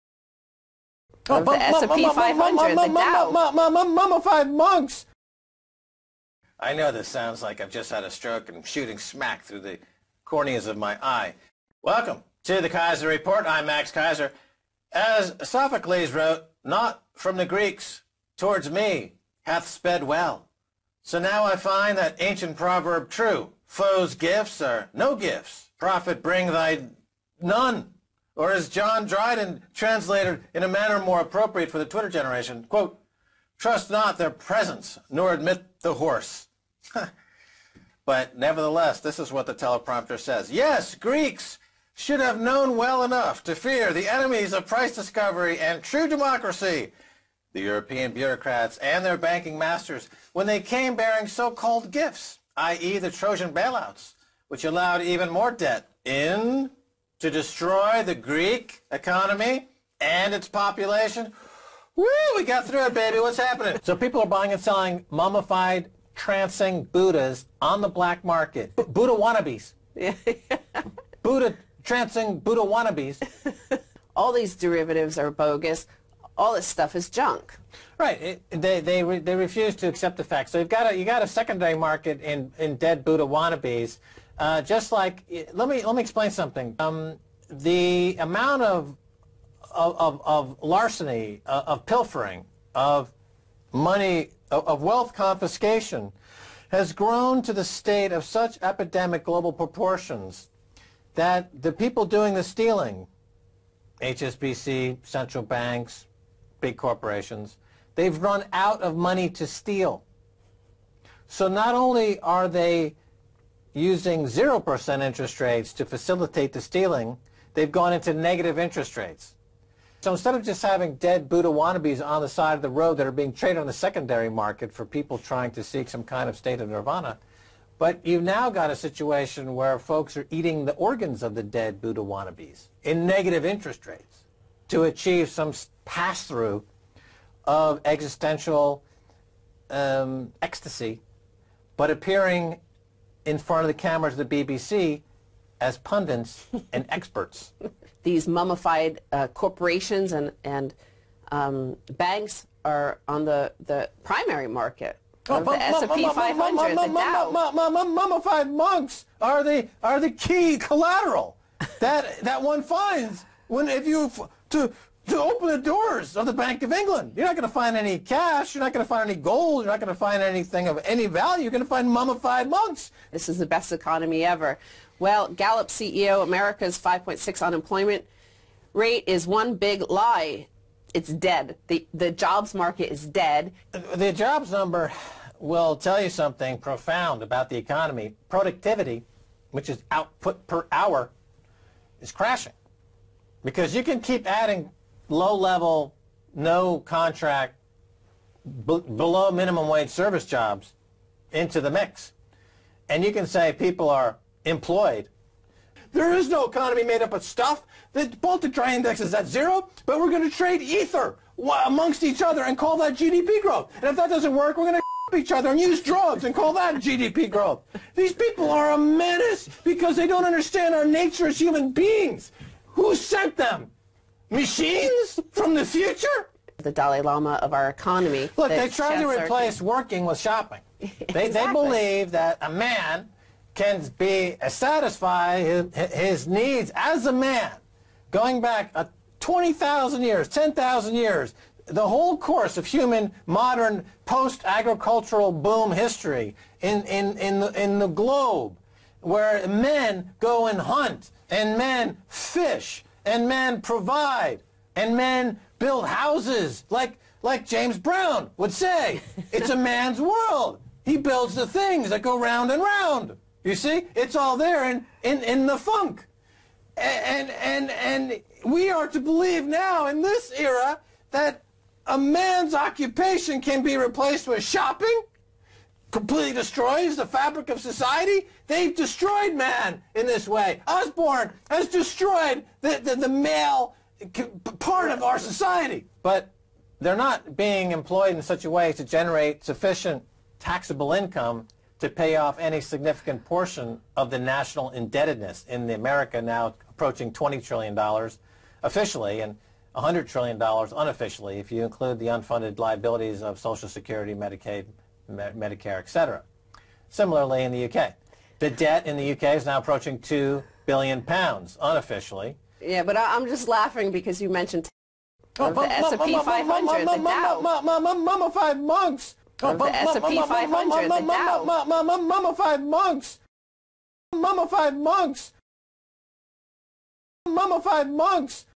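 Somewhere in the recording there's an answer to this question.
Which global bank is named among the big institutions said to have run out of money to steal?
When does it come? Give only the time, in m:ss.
1:44.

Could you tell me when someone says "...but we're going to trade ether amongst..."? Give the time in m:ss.
3:29.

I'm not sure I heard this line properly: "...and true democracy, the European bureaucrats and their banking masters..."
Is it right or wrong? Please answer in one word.
right.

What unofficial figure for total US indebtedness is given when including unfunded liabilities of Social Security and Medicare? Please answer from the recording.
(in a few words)
$100 trillion.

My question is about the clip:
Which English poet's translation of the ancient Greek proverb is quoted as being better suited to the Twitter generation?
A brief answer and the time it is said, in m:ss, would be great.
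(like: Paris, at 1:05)
John Dryden, at 0:28.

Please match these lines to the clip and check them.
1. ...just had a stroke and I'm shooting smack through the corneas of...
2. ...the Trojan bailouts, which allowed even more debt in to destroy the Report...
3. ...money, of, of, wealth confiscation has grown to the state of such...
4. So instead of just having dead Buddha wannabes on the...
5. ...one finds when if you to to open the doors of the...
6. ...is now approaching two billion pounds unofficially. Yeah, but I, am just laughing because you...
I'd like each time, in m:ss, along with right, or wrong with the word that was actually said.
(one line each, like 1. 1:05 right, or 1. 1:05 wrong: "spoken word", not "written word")
1. 0:07 right
2. 0:52 wrong: "Greek", not "Report"
3. 1:33 right
4. 2:00 right
5. 2:42 right
6. 5:09 right.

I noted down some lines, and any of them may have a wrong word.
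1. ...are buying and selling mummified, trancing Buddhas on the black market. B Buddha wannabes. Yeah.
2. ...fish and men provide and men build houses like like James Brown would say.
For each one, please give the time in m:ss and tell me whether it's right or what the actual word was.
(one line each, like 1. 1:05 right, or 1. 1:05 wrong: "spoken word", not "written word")
1. 1:04 right
2. 4:12 right.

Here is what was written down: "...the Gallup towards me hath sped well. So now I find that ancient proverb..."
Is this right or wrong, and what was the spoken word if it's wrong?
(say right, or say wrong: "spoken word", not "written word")
wrong: "Greeks", not "Gallup".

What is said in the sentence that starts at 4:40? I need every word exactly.
Osborne has destroyed the, the, the male part of our society.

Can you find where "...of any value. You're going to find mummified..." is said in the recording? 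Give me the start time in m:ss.
2:50.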